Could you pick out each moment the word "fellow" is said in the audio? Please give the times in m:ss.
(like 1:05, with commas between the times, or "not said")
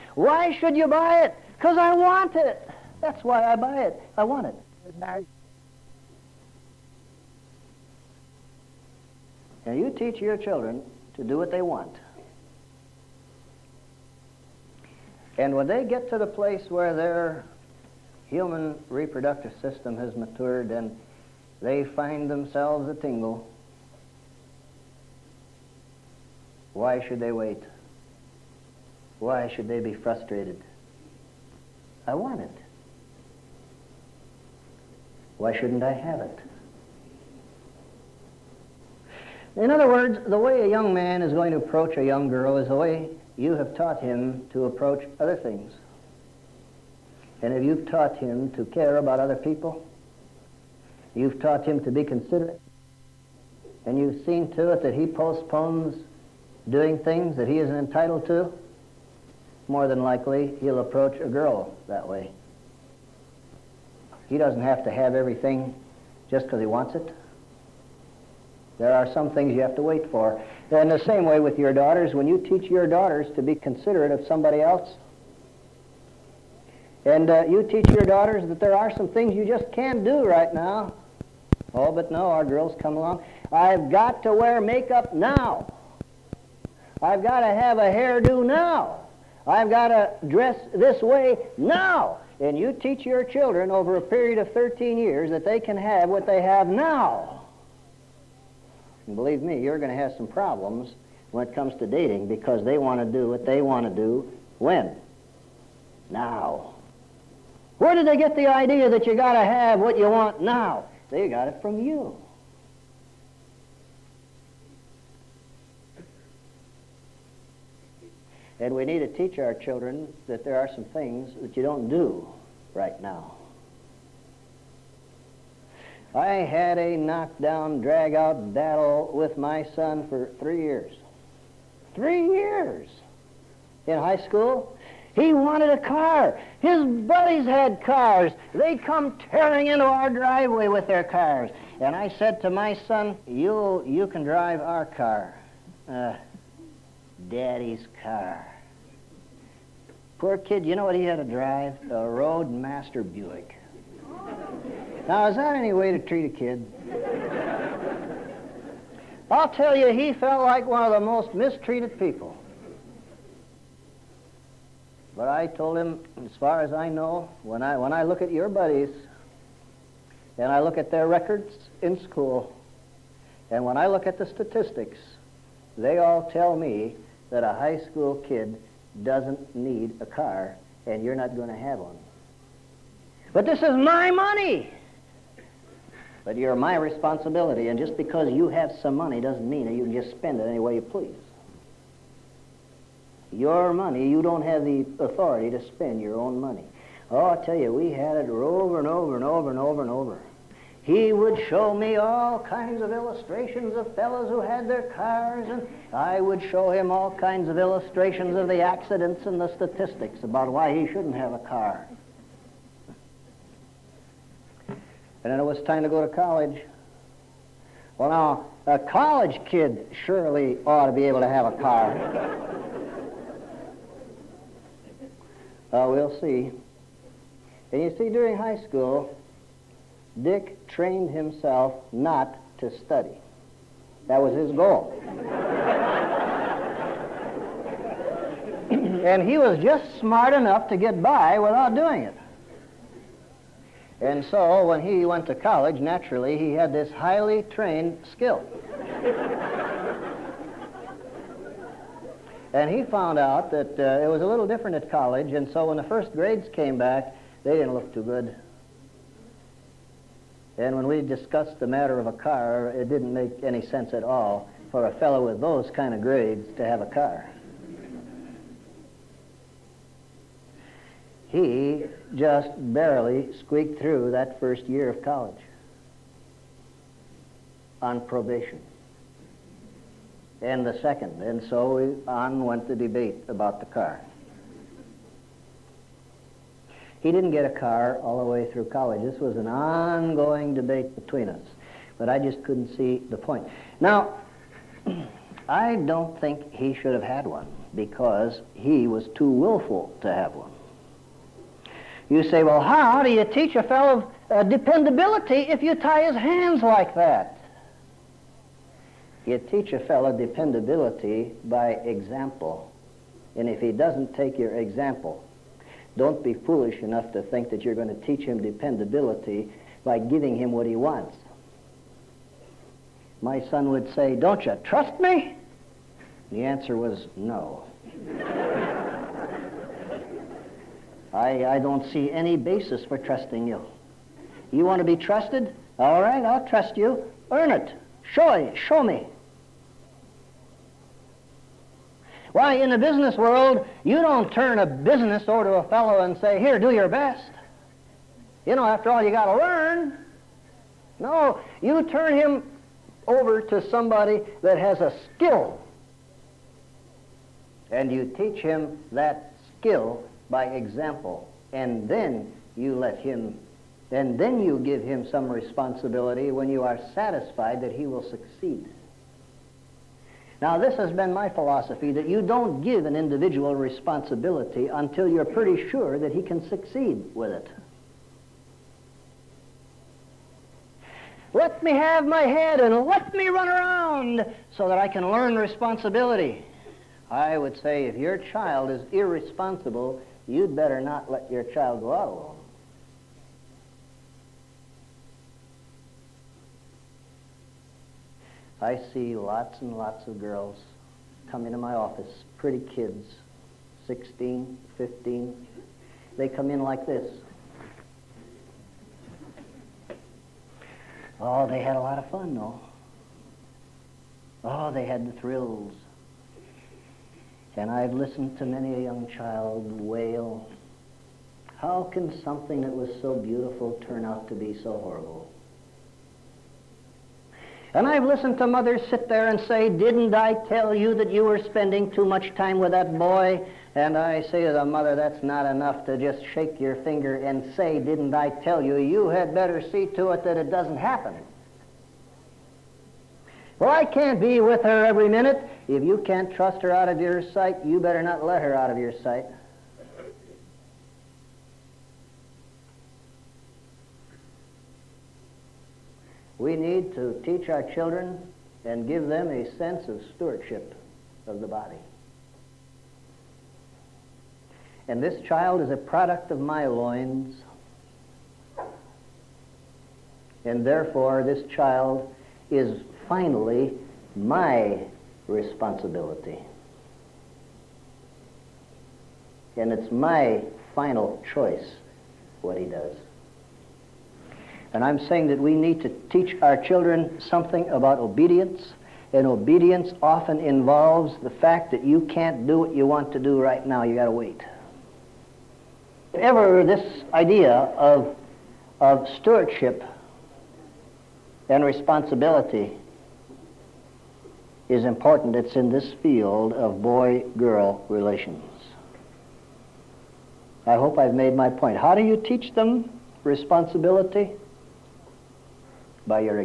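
3:23, 4:24, 5:03, 5:09, 5:45.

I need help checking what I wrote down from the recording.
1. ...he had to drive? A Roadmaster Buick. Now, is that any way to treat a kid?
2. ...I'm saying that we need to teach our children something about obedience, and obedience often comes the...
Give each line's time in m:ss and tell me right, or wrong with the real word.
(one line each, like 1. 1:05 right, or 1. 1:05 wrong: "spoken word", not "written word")
1. 2:30 right
2. 8:04 wrong: "involves", not "comes".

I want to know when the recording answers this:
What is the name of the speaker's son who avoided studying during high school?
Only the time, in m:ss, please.
3:50.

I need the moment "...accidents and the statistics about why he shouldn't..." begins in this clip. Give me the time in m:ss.
3:28.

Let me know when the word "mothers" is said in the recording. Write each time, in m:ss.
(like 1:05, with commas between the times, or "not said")
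7:08, 7:14.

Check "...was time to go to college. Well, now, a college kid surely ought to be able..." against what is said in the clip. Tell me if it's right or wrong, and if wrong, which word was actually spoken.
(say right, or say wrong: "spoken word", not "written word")
right.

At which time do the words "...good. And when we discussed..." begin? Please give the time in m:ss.
4:18.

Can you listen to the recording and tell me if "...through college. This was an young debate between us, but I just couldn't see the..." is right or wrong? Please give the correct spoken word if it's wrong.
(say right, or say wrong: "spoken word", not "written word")
wrong: "ongoing", not "young".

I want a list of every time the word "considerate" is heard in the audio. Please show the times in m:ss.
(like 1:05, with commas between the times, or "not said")
0:52, 1:13.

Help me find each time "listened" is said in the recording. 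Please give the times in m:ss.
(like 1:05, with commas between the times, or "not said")
6:57, 7:08.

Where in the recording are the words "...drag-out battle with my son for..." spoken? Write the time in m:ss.
2:07.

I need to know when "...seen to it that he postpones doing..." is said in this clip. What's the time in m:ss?
0:54.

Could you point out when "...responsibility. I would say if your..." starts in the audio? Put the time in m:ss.
6:25.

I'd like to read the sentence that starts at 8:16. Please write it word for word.
If ever this idea of, of stewardship and responsibility is important.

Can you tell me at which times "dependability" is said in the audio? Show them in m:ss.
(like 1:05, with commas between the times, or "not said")
5:04, 5:10, 5:18.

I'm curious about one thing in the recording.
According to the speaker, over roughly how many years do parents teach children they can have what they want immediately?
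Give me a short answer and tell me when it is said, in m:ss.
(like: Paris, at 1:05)
13 years, at 1:34.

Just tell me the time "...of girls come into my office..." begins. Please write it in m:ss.
6:40.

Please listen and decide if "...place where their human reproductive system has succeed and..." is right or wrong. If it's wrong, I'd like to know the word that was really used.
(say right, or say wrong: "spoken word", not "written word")
wrong: "matured", not "succeed".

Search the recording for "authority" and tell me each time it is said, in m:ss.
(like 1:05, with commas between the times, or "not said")
3:15.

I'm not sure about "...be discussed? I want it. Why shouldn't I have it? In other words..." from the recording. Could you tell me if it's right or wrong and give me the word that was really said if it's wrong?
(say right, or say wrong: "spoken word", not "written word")
wrong: "frustrated", not "discussed".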